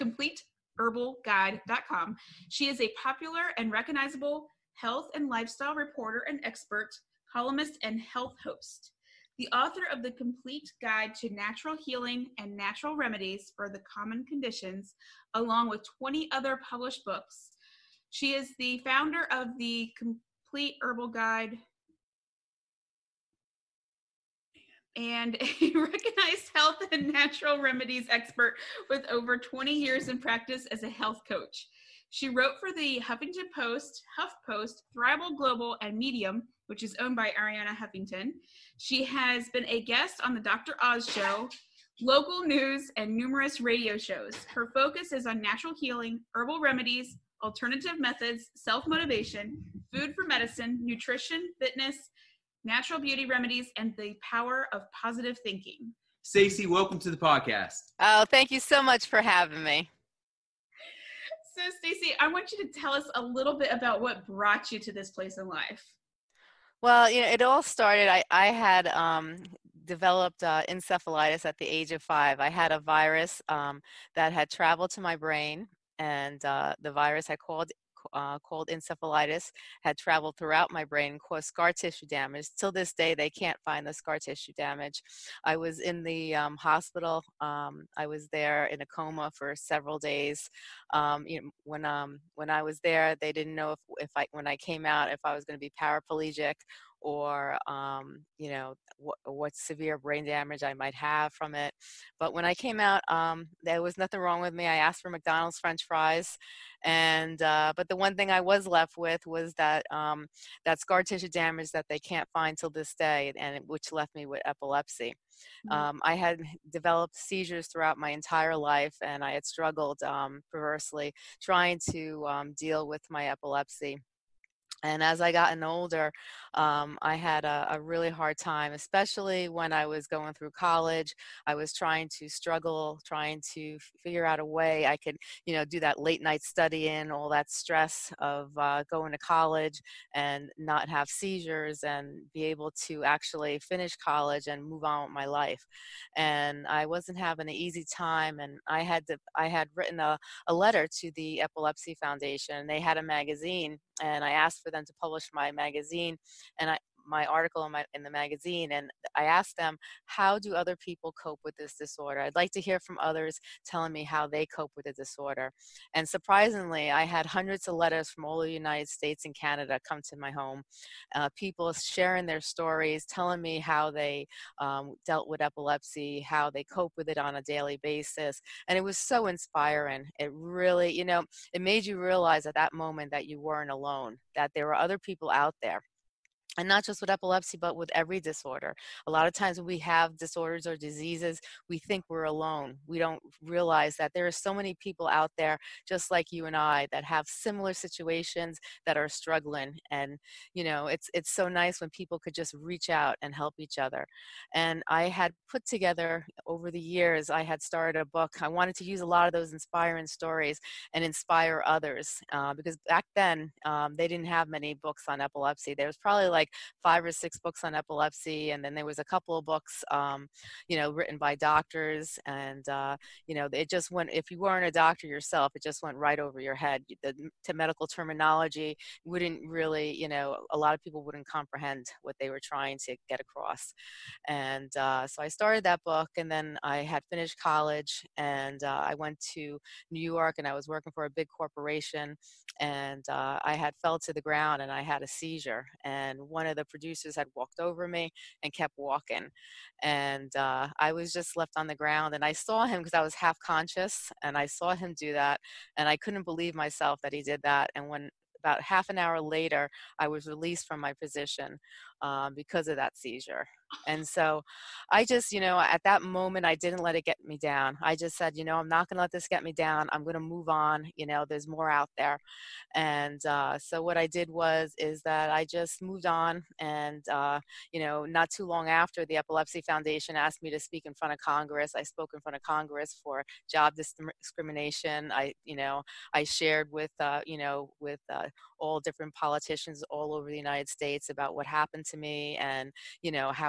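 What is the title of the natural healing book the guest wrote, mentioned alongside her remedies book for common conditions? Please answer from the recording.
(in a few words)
Complete Guide to Natural Healing.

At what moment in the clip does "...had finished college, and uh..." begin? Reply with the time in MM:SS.
03:56.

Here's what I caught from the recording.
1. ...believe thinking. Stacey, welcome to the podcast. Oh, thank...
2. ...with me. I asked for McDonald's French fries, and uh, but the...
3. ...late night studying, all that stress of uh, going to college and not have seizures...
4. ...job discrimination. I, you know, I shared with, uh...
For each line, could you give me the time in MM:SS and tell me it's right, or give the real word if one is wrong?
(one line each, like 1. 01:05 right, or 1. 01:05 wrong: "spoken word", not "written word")
1. 00:54 wrong: "positive", not "believe"
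2. 01:44 right
3. 02:15 right
4. 04:43 right.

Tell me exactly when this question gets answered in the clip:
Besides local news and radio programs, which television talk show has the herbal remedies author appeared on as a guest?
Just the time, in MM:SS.
00:40.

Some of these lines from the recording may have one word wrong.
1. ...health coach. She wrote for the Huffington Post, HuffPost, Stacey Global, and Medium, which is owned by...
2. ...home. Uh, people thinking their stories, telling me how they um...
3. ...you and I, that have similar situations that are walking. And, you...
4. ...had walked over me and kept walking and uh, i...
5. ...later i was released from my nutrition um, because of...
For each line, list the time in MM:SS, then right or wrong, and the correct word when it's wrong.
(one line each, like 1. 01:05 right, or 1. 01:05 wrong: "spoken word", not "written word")
1. 00:30 wrong: "Thrival", not "Stacey"
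2. 02:50 wrong: "sharing", not "thinking"
3. 03:16 wrong: "struggling", not "walking"
4. 04:07 right
5. 04:19 wrong: "position", not "nutrition".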